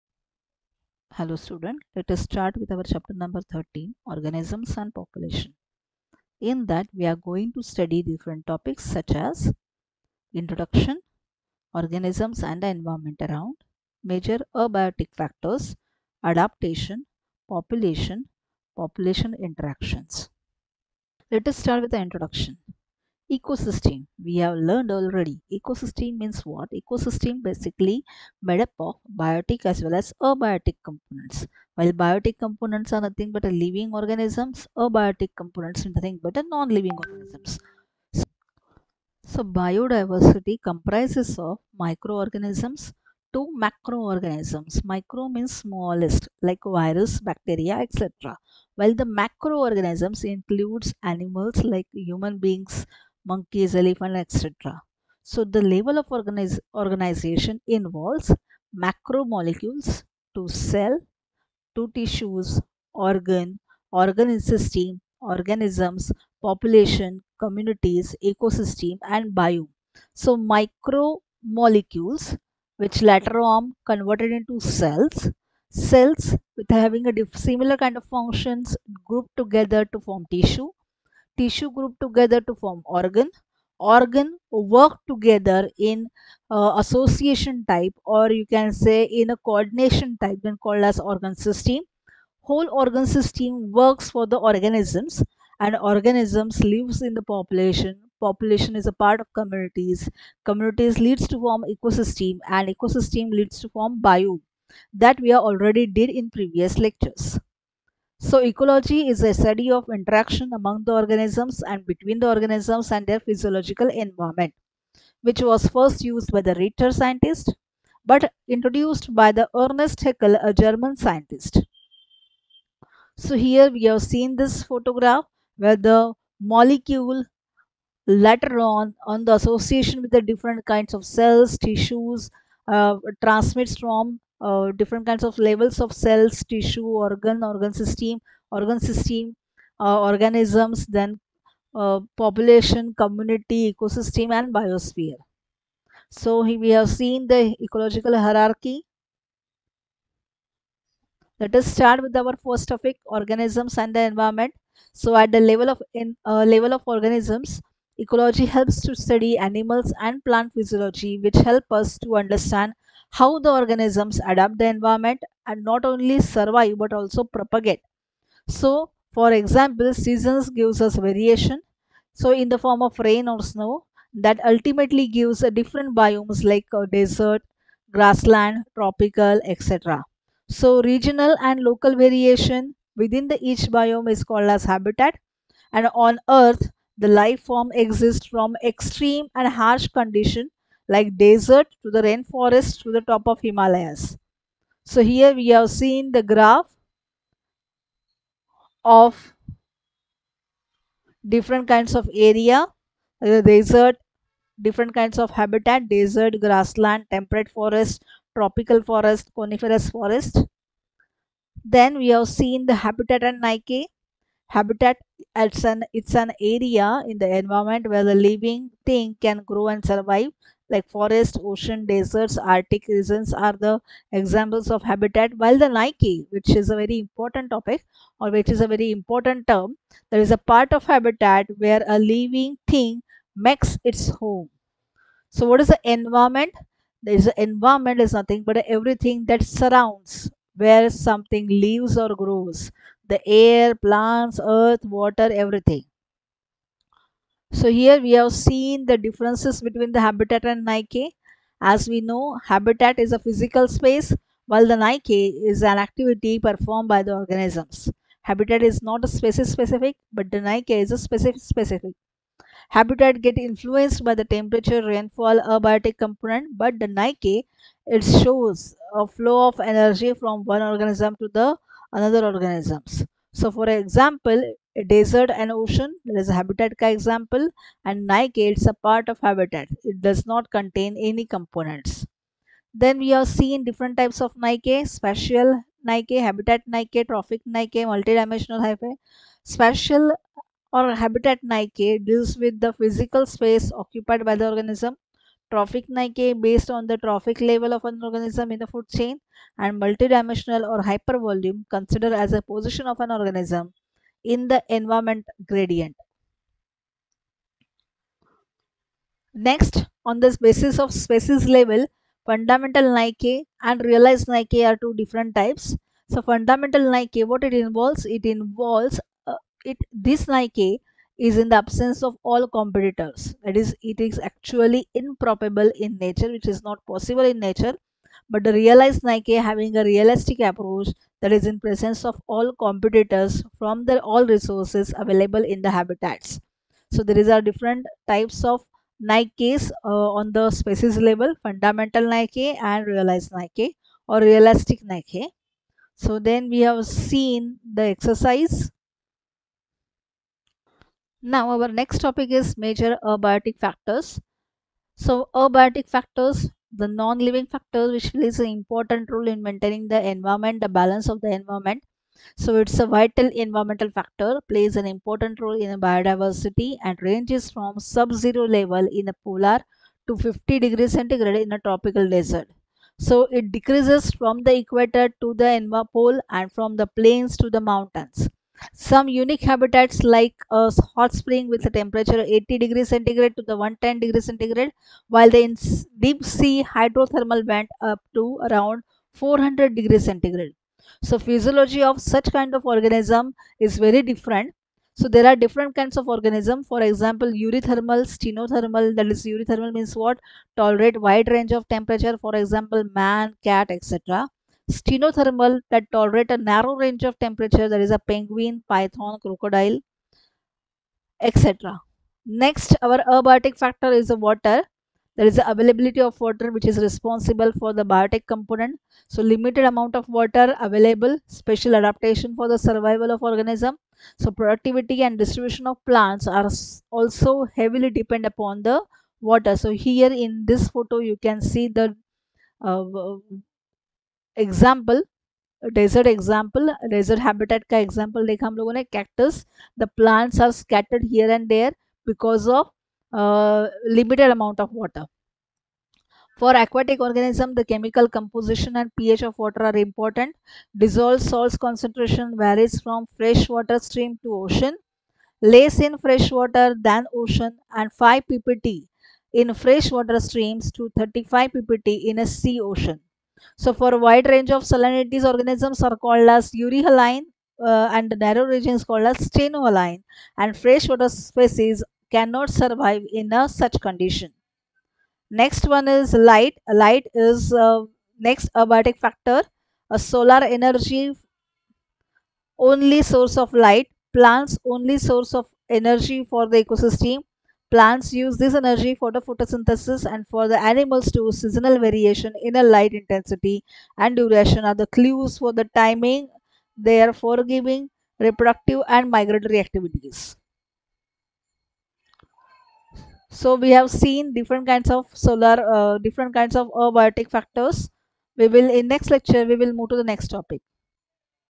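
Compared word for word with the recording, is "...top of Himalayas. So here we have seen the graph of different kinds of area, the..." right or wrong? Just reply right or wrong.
right.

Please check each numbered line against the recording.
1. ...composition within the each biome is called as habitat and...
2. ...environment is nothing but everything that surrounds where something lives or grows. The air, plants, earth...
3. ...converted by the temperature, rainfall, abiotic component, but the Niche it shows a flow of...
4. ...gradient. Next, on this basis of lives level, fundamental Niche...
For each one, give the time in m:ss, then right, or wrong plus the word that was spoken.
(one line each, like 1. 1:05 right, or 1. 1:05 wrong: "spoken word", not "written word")
1. 3:01 wrong: "variation", not "composition"
2. 3:57 right
3. 4:23 wrong: "influenced", not "converted"
4. 5:05 wrong: "species", not "lives".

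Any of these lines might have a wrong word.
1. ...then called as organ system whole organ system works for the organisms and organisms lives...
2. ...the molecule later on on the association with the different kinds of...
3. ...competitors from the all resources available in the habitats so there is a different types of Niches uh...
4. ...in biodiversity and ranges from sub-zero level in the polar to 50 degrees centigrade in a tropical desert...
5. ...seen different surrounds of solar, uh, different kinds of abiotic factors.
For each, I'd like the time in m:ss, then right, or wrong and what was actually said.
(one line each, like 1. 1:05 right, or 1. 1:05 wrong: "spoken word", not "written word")
1. 1:30 right
2. 2:05 right
3. 5:32 right
4. 6:05 right
5. 8:23 wrong: "kinds", not "surrounds".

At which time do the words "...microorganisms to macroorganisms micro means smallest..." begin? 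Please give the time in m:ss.
0:41.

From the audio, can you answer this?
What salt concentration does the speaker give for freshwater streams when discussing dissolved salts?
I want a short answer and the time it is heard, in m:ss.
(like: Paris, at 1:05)
5 ppt, at 7:38.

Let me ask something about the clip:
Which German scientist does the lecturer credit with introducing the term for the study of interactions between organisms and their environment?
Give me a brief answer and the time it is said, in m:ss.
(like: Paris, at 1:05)
Ernest Haeckel, at 1:59.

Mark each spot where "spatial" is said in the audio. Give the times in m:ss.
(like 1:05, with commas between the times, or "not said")
4:44, 4:49.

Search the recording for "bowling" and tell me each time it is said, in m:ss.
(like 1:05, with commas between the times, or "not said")
not said.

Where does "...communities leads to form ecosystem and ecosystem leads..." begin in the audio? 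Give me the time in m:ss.
1:40.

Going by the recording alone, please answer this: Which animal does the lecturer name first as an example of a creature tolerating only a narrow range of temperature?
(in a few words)
penguin.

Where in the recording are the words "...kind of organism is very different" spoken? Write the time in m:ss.
6:32.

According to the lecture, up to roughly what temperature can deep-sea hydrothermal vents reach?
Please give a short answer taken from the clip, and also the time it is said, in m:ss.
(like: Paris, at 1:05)
400 degrees centigrade, at 6:29.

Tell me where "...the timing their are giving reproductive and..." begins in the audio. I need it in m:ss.
8:15.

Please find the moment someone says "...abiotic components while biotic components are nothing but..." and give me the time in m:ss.
0:30.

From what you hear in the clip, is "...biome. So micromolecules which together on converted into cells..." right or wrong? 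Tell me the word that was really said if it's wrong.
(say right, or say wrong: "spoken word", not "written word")
wrong: "later", not "together".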